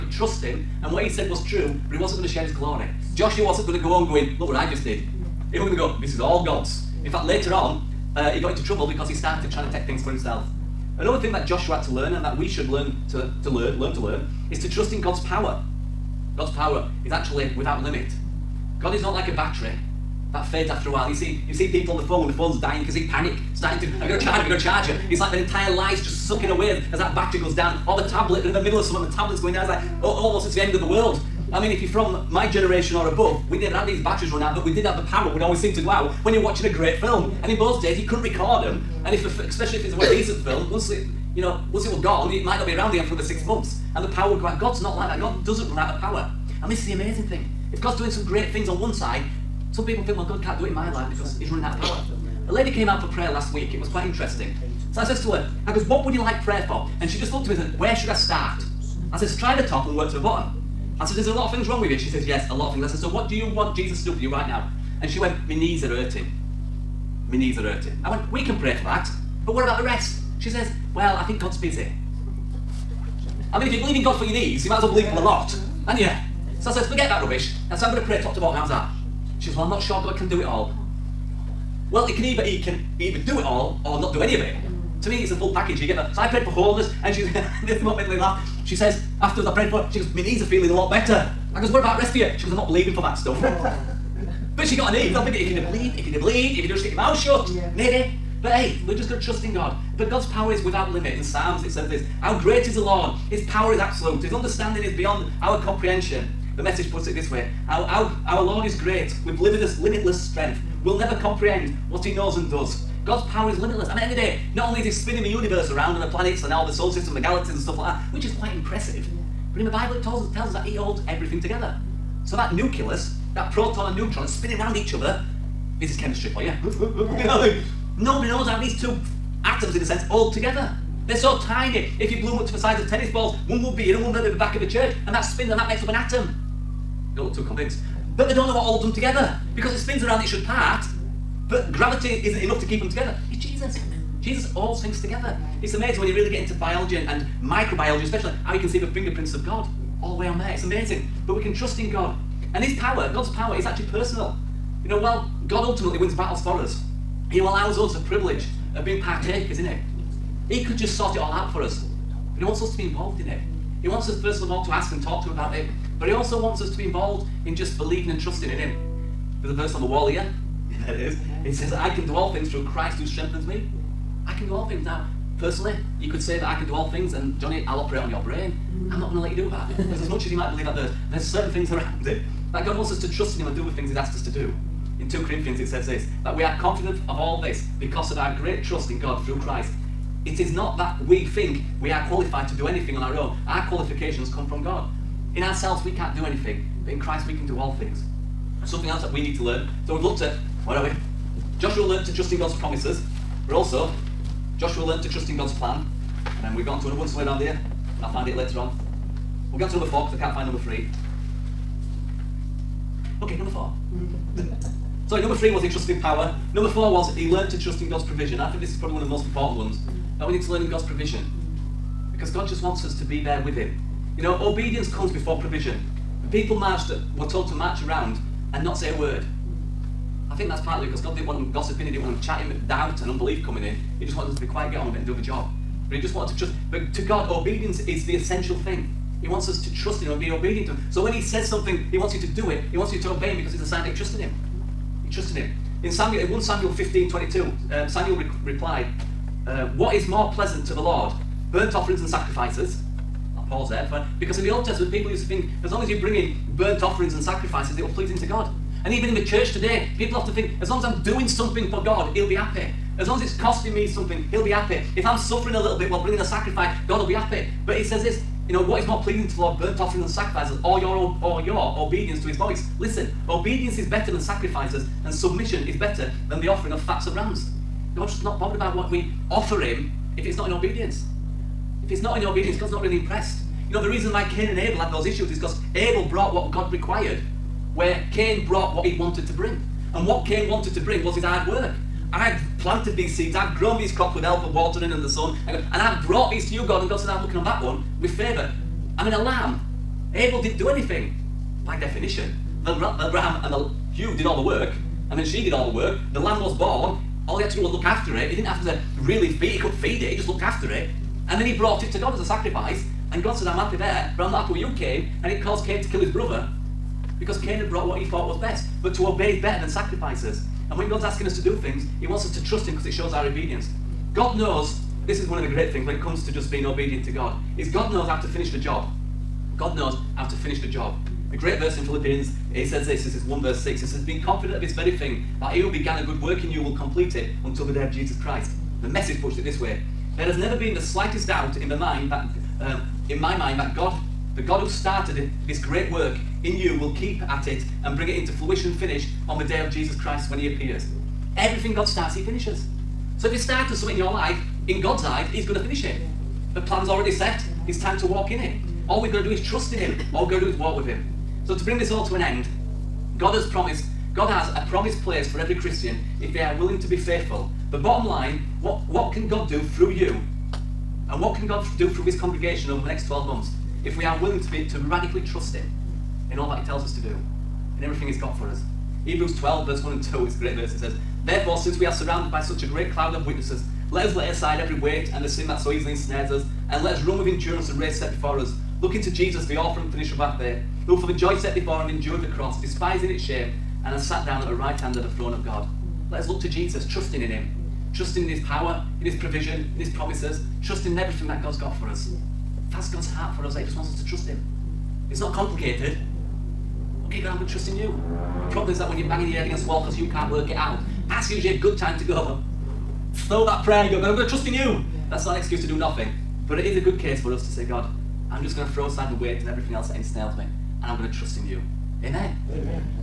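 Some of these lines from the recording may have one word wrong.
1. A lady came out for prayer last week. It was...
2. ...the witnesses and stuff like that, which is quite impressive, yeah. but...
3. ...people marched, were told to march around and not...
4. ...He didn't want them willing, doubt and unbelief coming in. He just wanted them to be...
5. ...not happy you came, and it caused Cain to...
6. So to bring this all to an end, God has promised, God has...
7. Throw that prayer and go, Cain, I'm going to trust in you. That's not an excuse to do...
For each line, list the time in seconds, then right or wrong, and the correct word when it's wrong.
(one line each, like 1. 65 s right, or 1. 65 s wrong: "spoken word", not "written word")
1. 52 s right
2. 117 s wrong: "galaxies", not "witnesses"
3. 226 s right
4. 231 s wrong: "chatting", not "willing"
5. 314 s right
6. 361 s right
7. 413 s wrong: "God", not "Cain".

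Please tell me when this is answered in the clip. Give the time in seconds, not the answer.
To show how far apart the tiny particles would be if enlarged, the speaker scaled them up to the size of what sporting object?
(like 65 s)
132 s.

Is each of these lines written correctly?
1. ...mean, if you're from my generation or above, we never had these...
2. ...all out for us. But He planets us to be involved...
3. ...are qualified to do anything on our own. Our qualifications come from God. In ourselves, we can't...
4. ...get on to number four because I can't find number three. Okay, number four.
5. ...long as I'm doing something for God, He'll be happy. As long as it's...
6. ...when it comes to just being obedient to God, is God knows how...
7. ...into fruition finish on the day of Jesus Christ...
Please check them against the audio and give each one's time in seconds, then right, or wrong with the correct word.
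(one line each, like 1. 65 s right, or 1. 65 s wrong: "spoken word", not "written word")
1. 31 s right
2. 161 s wrong: "wants", not "planets"
3. 191 s right
4. 209 s right
5. 260 s right
6. 325 s right
7. 348 s right.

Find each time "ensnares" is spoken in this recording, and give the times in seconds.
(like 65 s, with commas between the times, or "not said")
385 s, 419 s.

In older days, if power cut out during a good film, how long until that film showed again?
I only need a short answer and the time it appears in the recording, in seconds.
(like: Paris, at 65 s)
six months, at 43 s.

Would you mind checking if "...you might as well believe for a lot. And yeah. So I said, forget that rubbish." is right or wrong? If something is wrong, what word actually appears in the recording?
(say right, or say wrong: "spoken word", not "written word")
right.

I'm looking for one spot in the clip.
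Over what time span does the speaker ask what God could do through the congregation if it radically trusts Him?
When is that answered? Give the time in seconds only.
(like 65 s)
373 s.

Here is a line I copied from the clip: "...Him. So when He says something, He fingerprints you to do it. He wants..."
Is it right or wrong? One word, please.
wrong.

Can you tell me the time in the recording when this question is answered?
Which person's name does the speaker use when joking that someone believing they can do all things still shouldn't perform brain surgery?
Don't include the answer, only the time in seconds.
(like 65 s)
177 s.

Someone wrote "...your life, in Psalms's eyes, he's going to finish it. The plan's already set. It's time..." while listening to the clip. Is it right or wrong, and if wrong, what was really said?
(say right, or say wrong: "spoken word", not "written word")
wrong: "God", not "Psalms".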